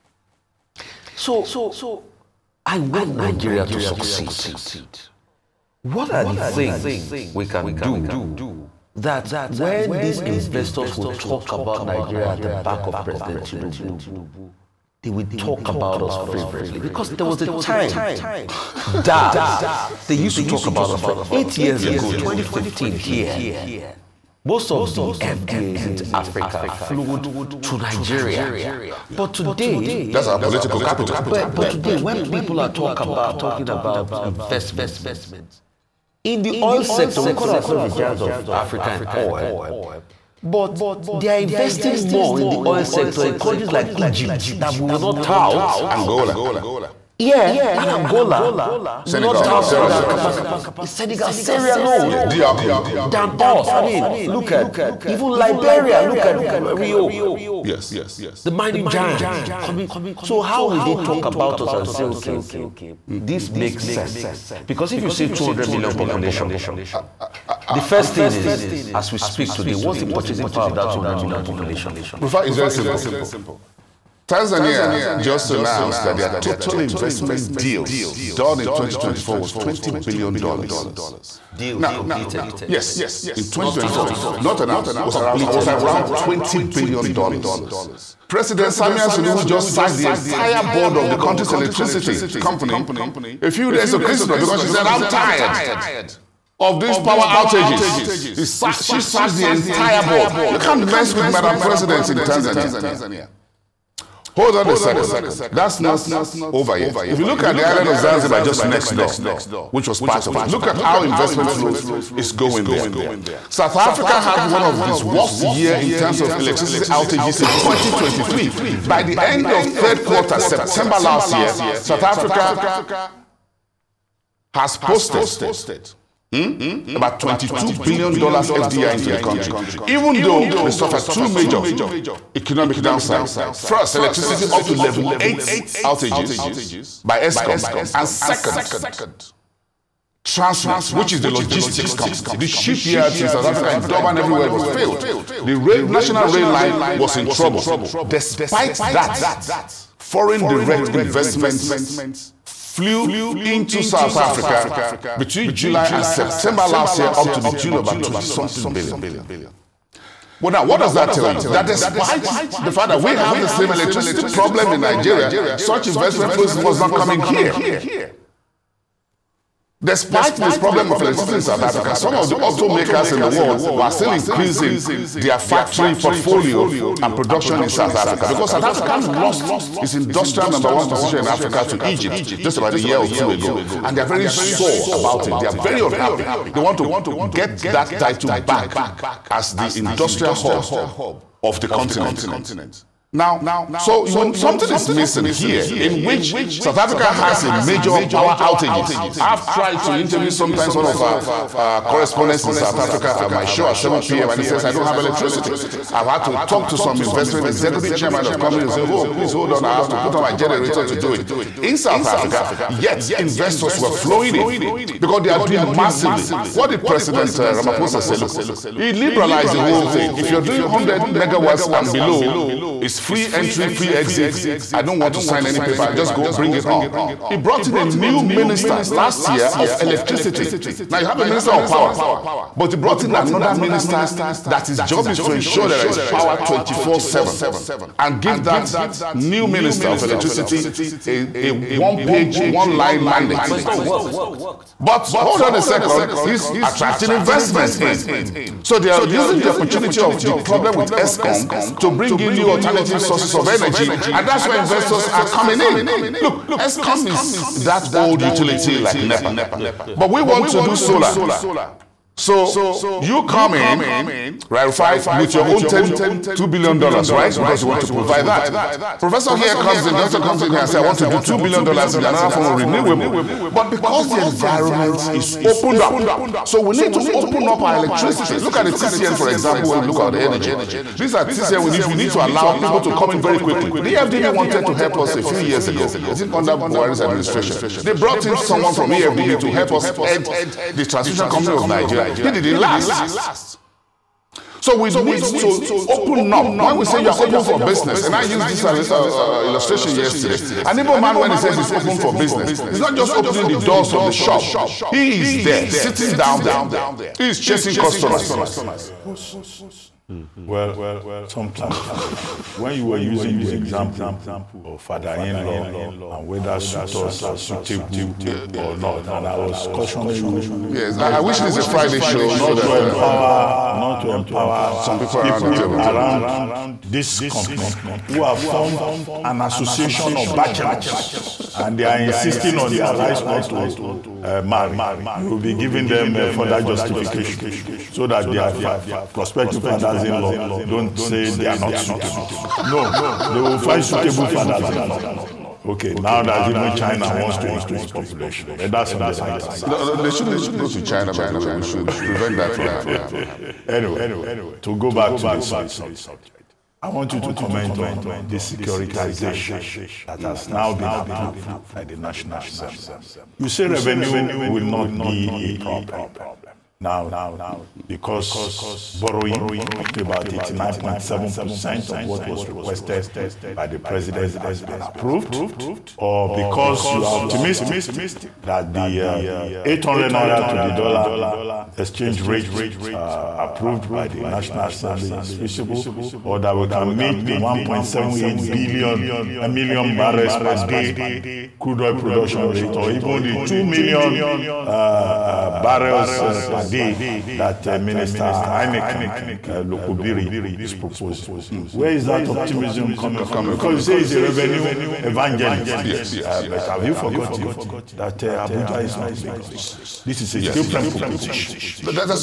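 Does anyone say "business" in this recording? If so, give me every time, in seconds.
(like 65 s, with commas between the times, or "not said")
297 s, 302 s.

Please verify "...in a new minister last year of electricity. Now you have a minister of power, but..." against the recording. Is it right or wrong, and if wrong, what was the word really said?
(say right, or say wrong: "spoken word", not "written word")
right.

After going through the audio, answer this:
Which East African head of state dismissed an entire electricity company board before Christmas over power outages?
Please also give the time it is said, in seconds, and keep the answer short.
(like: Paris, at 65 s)
Samia Suluhu, at 88 s.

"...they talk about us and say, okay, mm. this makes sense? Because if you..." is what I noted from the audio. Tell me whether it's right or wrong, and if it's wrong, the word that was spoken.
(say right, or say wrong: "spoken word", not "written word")
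right.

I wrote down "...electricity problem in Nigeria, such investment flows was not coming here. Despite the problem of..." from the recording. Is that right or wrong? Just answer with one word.
right.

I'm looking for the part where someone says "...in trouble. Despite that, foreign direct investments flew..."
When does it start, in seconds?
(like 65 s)
147 s.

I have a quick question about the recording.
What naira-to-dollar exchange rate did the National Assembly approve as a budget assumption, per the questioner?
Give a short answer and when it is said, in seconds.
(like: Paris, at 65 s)
800 naira, at 379 s.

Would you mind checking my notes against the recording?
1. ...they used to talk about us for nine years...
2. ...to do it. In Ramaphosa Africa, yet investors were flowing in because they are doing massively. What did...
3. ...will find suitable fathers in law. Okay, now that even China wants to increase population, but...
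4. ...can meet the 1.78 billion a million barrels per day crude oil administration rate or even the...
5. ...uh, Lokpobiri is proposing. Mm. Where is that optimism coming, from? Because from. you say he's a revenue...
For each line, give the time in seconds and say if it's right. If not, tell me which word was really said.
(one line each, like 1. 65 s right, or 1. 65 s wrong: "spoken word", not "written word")
1. 20 s wrong: "eight", not "nine"
2. 210 s wrong: "South", not "Ramaphosa"
3. 343 s right
4. 386 s wrong: "production", not "administration"
5. 399 s right.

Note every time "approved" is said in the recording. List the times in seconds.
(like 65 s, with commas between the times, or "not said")
360 s, 374 s, 383 s.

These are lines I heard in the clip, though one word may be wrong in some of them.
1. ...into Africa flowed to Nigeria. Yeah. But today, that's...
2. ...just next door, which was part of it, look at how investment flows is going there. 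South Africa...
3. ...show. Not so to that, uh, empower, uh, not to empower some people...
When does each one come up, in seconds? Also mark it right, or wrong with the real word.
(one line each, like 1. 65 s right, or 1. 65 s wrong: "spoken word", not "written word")
1. 25 s right
2. 108 s right
3. 322 s right.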